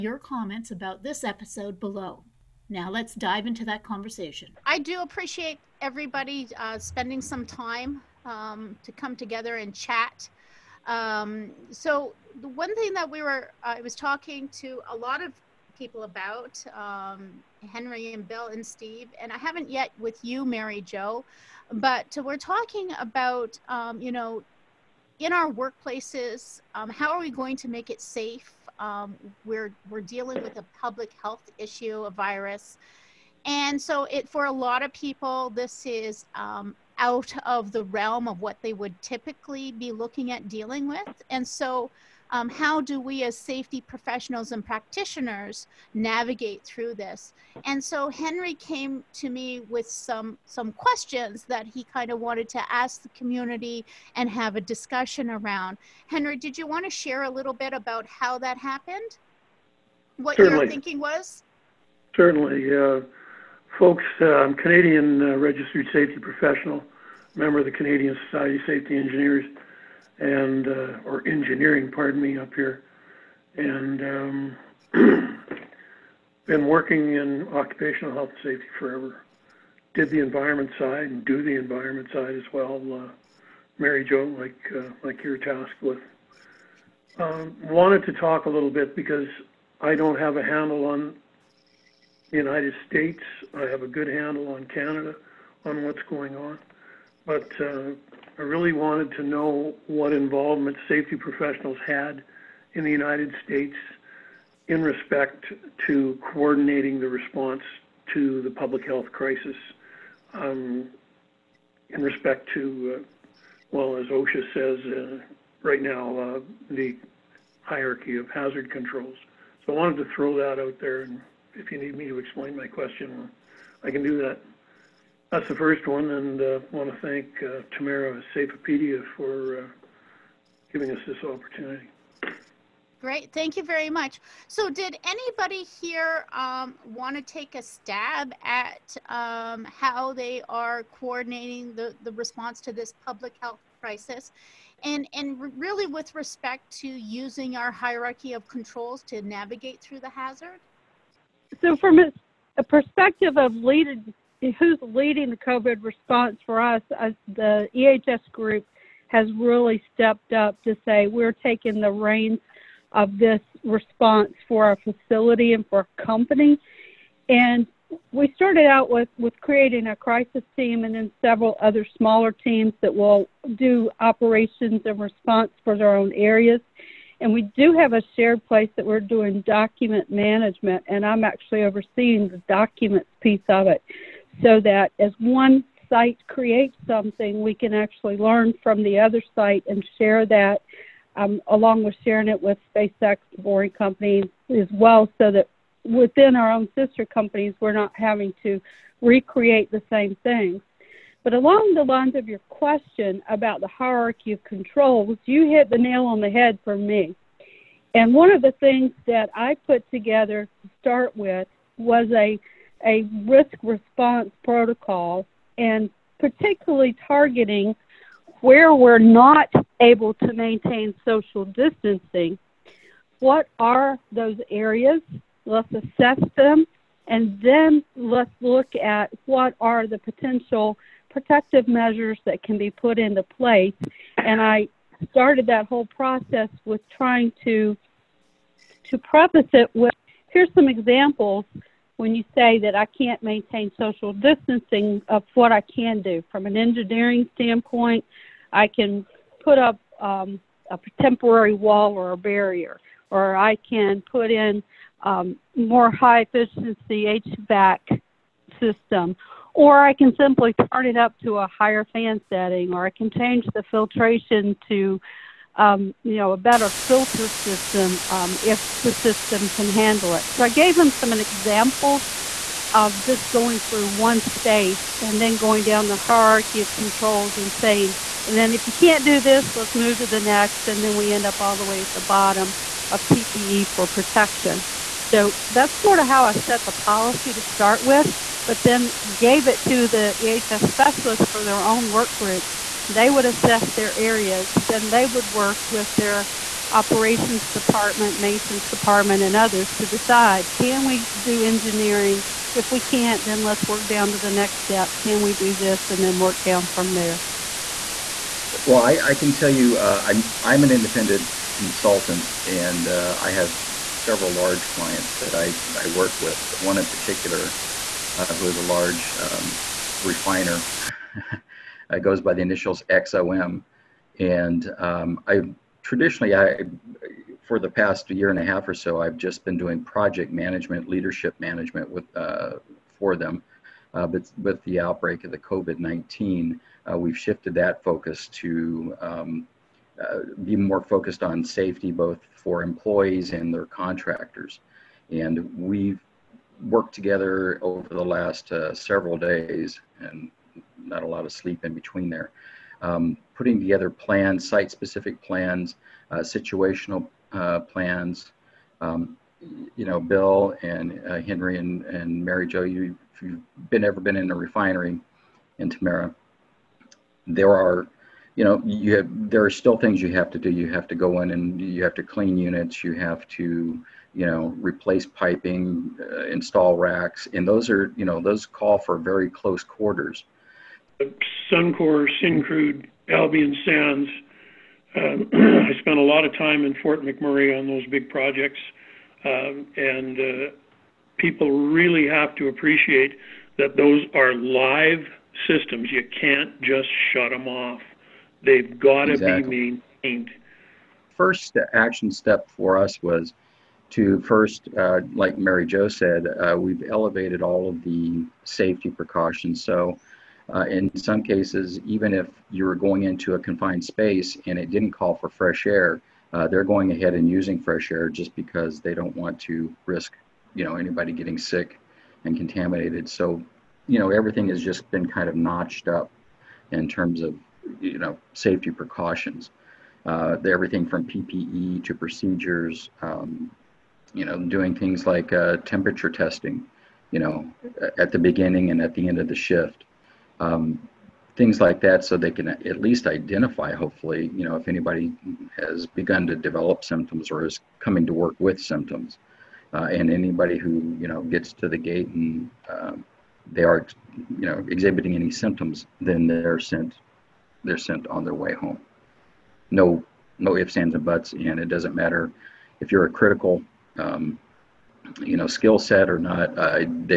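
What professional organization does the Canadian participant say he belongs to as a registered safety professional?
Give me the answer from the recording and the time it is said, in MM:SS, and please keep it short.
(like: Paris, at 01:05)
Canadian Society of Safety Engineers, at 01:07.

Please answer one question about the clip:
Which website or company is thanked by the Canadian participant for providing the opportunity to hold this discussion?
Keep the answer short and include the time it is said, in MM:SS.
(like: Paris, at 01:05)
Safeopedia, at 02:08.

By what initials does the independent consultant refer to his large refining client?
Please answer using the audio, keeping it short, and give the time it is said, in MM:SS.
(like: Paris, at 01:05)
XOM, at 05:22.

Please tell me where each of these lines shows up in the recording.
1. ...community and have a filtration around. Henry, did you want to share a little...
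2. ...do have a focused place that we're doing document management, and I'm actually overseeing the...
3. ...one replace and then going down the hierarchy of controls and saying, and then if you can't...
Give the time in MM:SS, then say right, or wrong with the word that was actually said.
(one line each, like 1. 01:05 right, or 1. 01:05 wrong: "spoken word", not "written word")
1. 00:53 wrong: "discussion", not "filtration"
2. 02:57 wrong: "shared", not "focused"
3. 04:33 wrong: "space", not "replace".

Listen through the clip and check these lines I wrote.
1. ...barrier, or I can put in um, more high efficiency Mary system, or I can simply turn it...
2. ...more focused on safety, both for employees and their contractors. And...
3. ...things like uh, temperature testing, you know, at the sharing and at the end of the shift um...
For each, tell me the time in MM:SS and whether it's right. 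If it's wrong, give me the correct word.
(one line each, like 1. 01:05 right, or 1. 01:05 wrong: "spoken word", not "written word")
1. 04:12 wrong: "HVAC", not "Mary"
2. 05:40 right
3. 07:14 wrong: "beginning", not "sharing".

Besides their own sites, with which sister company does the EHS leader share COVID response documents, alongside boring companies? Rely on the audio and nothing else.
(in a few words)
SpaceX.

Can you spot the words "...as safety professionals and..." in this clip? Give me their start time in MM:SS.
00:43.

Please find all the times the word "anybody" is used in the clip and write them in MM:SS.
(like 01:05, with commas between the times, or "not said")
02:15, 07:00, 07:24, 07:30.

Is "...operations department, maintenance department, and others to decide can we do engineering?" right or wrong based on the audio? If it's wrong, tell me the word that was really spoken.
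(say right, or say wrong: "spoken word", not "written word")
right.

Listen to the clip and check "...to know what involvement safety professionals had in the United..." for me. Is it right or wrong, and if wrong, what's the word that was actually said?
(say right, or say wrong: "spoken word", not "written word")
right.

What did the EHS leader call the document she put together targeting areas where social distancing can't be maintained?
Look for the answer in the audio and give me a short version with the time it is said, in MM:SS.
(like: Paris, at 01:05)
risk response protocol, at 03:33.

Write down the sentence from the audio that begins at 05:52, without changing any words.
Um, putting together plans, site-specific plans, uh, situational uh, plans.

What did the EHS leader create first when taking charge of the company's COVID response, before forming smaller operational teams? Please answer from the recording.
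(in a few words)
a crisis team.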